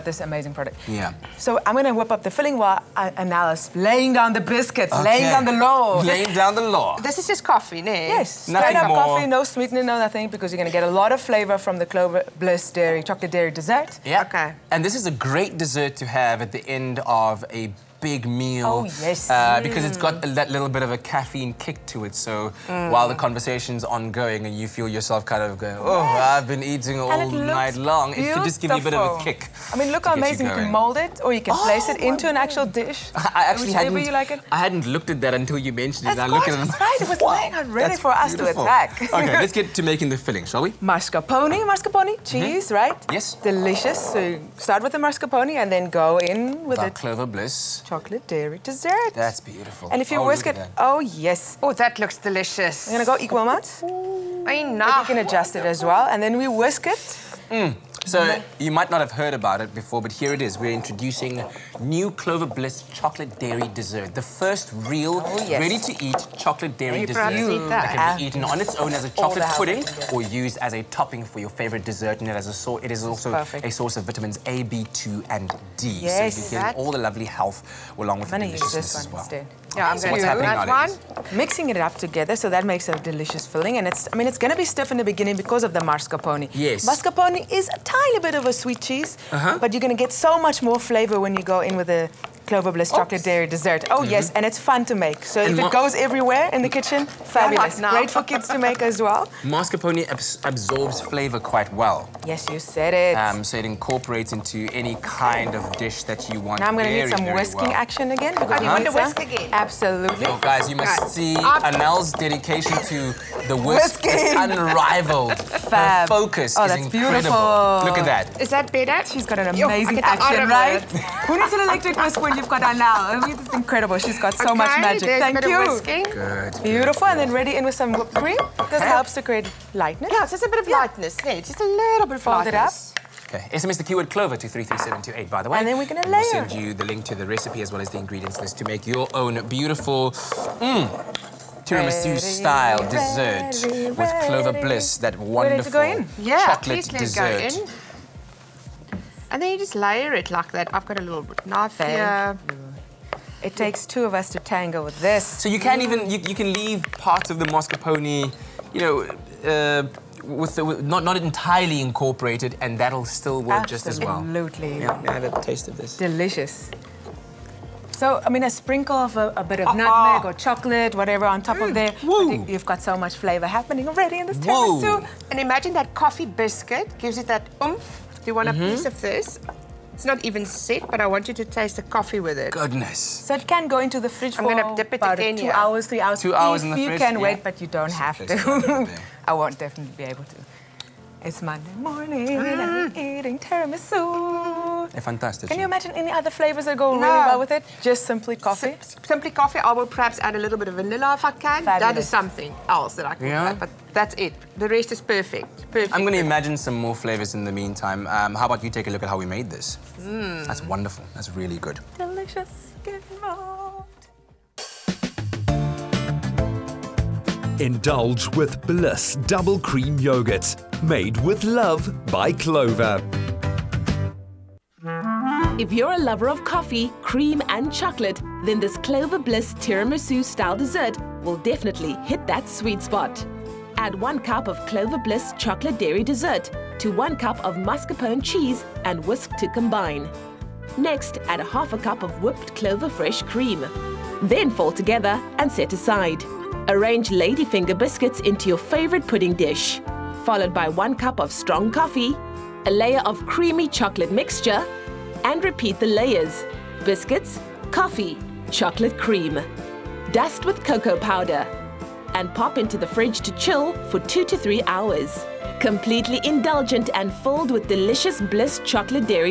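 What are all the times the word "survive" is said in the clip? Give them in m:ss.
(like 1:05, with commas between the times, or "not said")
not said.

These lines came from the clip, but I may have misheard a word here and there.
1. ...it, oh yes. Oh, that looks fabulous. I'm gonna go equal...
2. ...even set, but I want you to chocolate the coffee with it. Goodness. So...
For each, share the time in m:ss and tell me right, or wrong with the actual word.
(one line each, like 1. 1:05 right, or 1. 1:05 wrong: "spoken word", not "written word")
1. 0:50 wrong: "delicious", not "fabulous"
2. 3:00 wrong: "taste", not "chocolate".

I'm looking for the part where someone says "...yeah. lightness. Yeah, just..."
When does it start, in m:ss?
2:10.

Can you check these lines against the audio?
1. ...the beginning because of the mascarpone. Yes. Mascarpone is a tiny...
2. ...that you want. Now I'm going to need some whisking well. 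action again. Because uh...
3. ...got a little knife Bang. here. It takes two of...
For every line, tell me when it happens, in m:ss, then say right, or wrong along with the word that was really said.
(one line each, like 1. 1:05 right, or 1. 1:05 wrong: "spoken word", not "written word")
1. 1:24 right
2. 1:46 right
3. 2:30 right.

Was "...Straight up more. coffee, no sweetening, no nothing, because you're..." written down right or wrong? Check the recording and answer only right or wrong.
right.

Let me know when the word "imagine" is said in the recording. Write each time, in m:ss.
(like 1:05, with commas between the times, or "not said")
2:55, 3:15, 3:26.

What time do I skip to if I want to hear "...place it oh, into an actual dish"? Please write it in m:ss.
0:31.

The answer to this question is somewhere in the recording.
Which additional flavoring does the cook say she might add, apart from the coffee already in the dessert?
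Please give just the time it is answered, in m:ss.
3:20.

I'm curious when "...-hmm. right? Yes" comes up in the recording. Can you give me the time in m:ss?
0:42.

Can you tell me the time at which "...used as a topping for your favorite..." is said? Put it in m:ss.
1:10.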